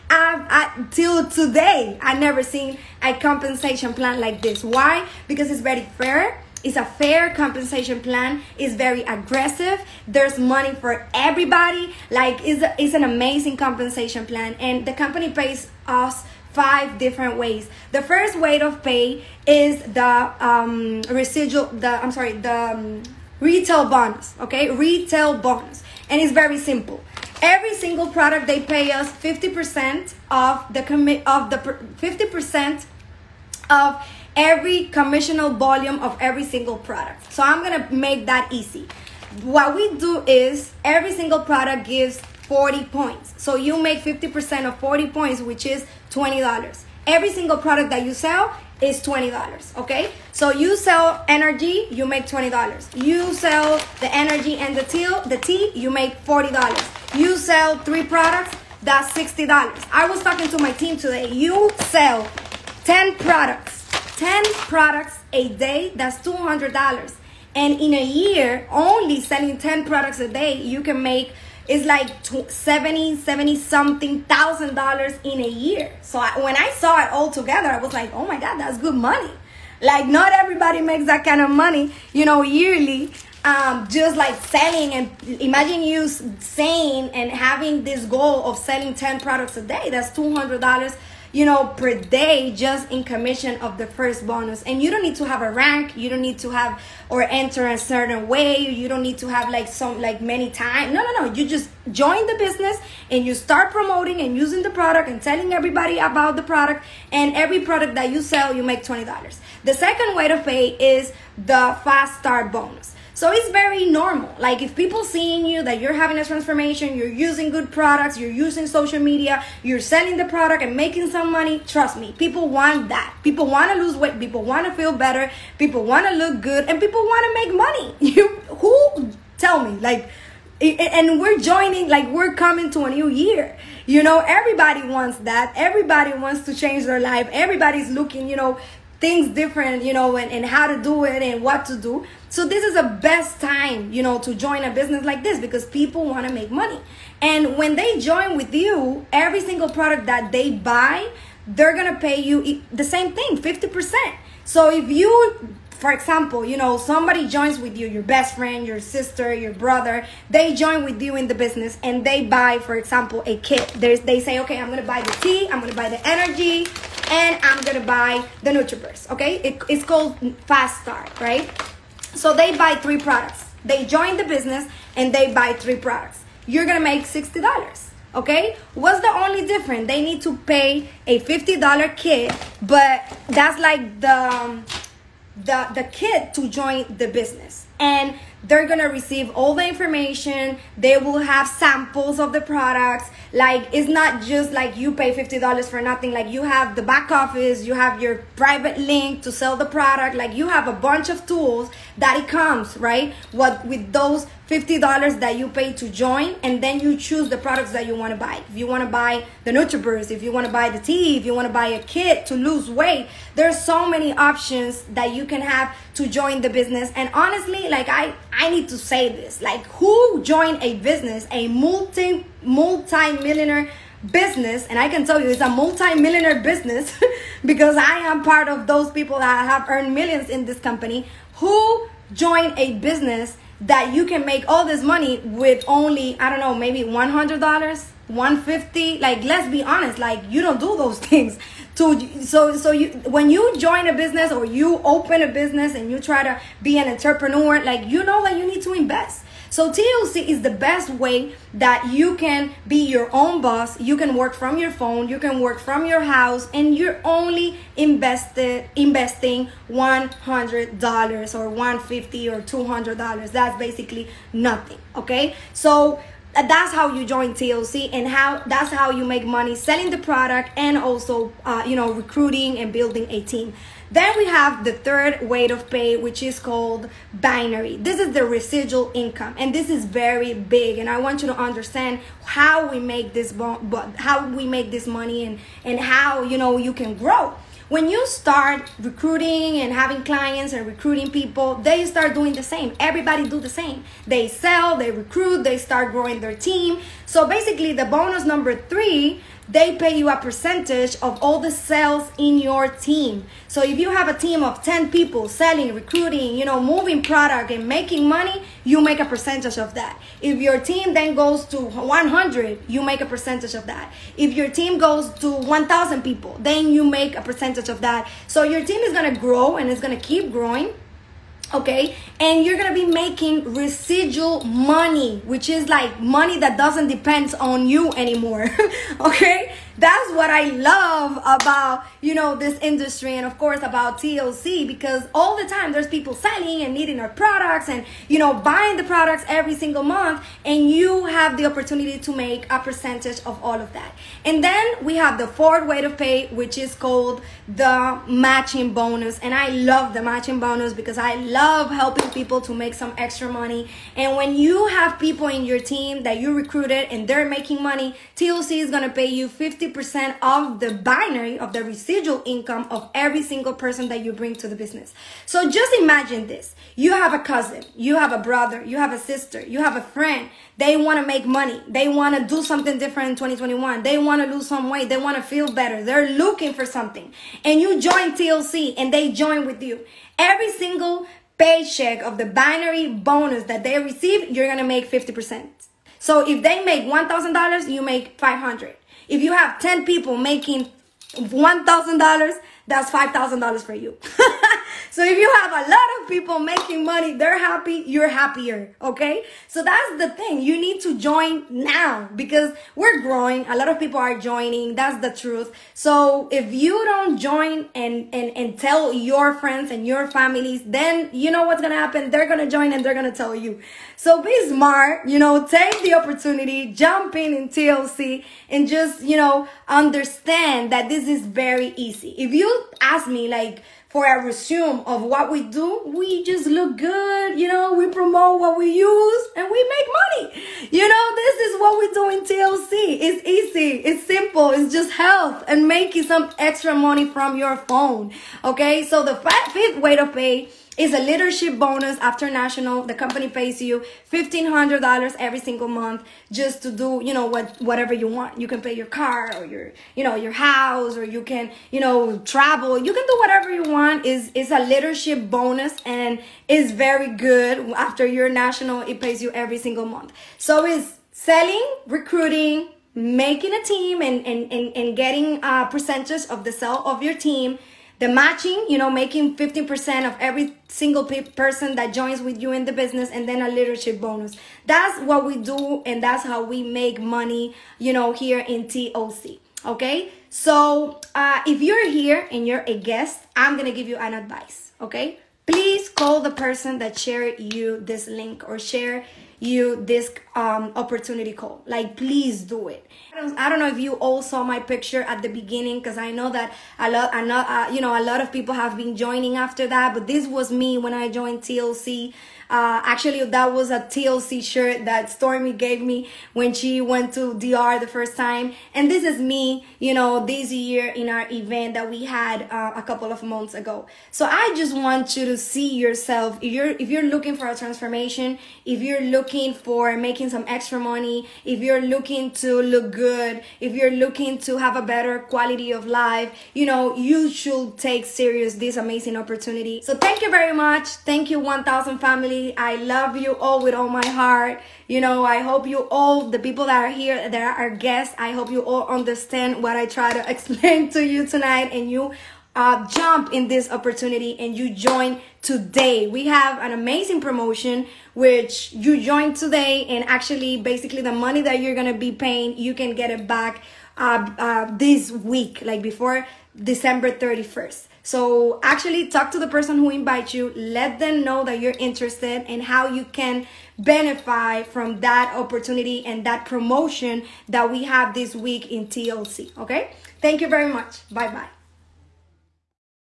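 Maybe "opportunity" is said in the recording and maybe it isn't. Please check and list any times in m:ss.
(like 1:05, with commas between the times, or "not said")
5:41, 6:55, 8:10, 8:49, 9:03, 9:25.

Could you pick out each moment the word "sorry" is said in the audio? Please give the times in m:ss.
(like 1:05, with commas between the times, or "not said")
0:22.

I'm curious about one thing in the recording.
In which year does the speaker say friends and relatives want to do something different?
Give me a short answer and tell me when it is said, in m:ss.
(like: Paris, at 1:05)
2021, at 6:13.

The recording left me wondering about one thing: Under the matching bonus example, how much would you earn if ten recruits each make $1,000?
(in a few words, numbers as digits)
$5,000.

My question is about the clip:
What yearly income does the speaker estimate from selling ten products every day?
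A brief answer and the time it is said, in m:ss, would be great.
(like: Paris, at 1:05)
70 something thousand dollars, at 1:12.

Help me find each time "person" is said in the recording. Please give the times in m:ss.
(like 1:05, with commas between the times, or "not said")
6:03, 7:51, 8:06, 9:19.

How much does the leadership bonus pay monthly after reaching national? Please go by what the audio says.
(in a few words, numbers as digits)
$1,500.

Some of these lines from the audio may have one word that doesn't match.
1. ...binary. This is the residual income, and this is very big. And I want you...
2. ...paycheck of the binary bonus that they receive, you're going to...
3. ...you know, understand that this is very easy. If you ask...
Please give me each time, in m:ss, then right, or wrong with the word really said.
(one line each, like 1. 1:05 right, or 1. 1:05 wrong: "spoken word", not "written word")
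1. 4:37 right
2. 6:21 right
3. 6:59 right.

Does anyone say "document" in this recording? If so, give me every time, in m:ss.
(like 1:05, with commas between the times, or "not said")
not said.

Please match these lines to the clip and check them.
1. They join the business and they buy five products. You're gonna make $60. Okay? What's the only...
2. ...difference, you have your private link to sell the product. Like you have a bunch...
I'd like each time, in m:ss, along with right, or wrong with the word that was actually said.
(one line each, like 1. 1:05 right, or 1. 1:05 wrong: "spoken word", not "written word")
1. 2:53 wrong: "three", not "five"
2. 3:17 wrong: "office", not "difference".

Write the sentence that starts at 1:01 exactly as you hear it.
You sell 10 products, 10 products a day, that's $200.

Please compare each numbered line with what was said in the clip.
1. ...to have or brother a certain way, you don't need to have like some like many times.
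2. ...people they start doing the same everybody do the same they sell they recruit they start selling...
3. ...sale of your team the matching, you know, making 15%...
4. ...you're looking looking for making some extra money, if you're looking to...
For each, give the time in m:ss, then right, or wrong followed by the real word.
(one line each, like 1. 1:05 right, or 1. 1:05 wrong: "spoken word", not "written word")
1. 1:36 wrong: "enter", not "brother"
2. 4:51 wrong: "growing", not "selling"
3. 7:46 right
4. 8:38 right.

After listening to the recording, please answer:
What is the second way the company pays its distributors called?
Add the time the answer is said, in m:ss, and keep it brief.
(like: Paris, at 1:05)
Fast start bonus, at 1:51.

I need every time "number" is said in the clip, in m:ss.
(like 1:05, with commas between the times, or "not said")
4:58.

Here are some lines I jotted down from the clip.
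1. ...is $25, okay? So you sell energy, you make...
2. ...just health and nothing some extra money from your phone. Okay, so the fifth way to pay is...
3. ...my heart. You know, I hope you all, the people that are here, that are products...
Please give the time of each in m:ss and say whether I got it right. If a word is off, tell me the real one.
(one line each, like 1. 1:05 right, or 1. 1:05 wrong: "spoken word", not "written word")
1. 0:48 wrong: "20", not "25"
2. 7:14 wrong: "making", not "nothing"
3. 8:53 wrong: "guests", not "products".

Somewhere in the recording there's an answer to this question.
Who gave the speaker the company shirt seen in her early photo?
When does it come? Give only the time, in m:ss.
8:25.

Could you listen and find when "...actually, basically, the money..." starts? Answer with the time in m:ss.
9:10.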